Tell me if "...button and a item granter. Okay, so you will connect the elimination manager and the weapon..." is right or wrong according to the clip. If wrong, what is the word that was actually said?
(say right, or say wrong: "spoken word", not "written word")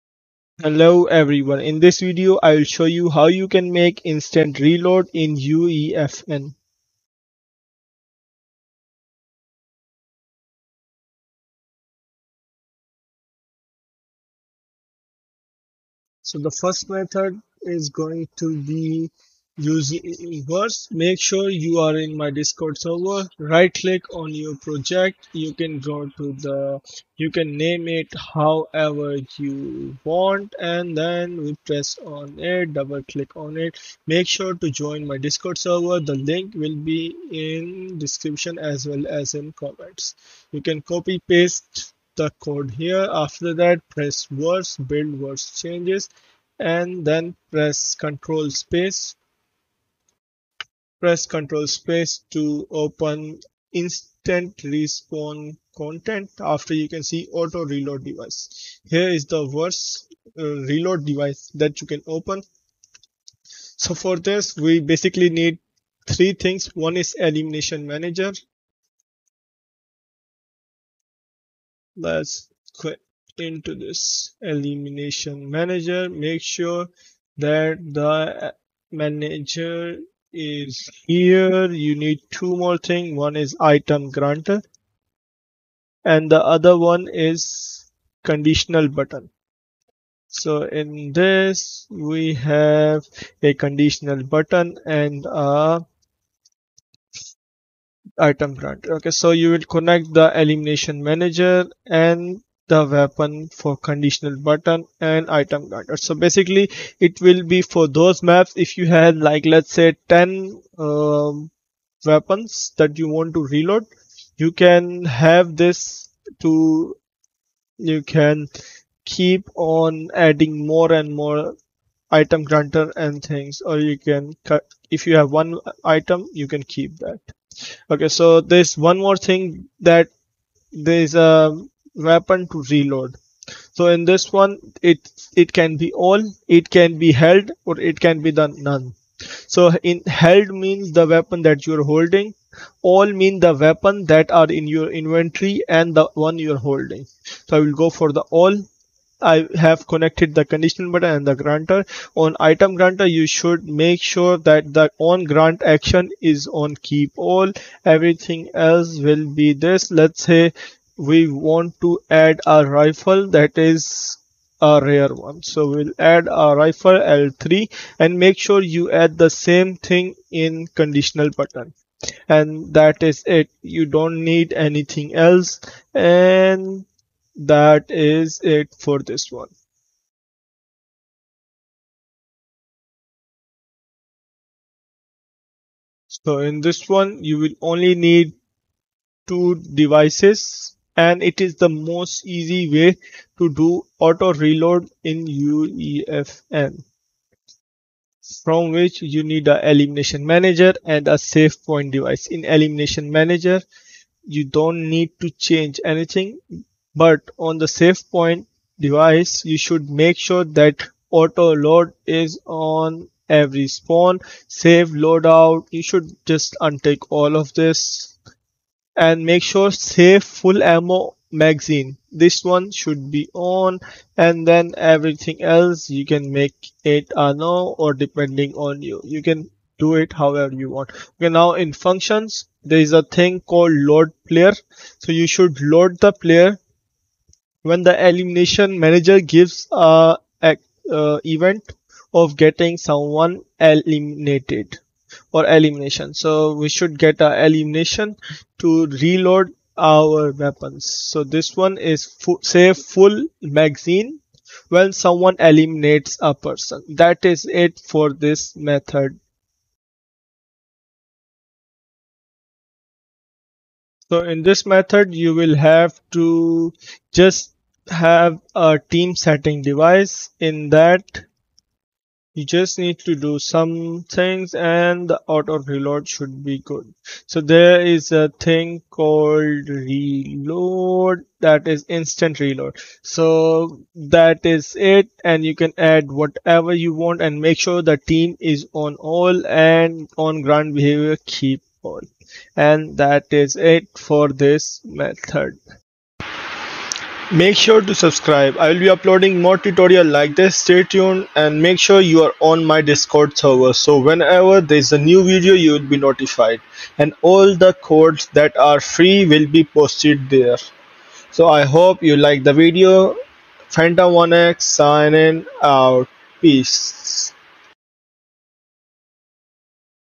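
right.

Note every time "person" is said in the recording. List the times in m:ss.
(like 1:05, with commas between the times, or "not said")
4:16.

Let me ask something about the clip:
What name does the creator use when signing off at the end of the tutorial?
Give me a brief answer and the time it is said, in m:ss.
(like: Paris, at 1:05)
Phantom 1X, at 5:13.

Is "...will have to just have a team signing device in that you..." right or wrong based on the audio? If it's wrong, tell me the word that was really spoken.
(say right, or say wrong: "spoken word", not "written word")
wrong: "setting", not "signing".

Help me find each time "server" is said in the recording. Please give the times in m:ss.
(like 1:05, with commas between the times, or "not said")
0:22, 0:35, 5:03.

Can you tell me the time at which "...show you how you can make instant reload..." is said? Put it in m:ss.
0:02.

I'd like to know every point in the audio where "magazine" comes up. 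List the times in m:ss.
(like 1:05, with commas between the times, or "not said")
3:41, 4:13.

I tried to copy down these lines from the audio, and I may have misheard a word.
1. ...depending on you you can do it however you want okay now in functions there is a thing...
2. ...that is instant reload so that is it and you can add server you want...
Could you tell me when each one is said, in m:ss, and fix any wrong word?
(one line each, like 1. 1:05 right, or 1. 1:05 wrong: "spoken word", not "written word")
1. 3:47 right
2. 4:41 wrong: "whatever", not "server".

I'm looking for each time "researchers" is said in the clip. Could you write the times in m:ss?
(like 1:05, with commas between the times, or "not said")
not said.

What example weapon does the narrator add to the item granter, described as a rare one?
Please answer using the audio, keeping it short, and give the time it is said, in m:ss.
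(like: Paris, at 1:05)
Rifle L3, at 2:46.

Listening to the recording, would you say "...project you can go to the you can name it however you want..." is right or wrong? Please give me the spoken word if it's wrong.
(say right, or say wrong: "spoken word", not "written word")
right.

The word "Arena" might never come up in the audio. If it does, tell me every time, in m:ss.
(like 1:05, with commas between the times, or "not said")
not said.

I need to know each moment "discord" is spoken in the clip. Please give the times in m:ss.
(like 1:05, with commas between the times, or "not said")
0:22, 0:35, 5:02.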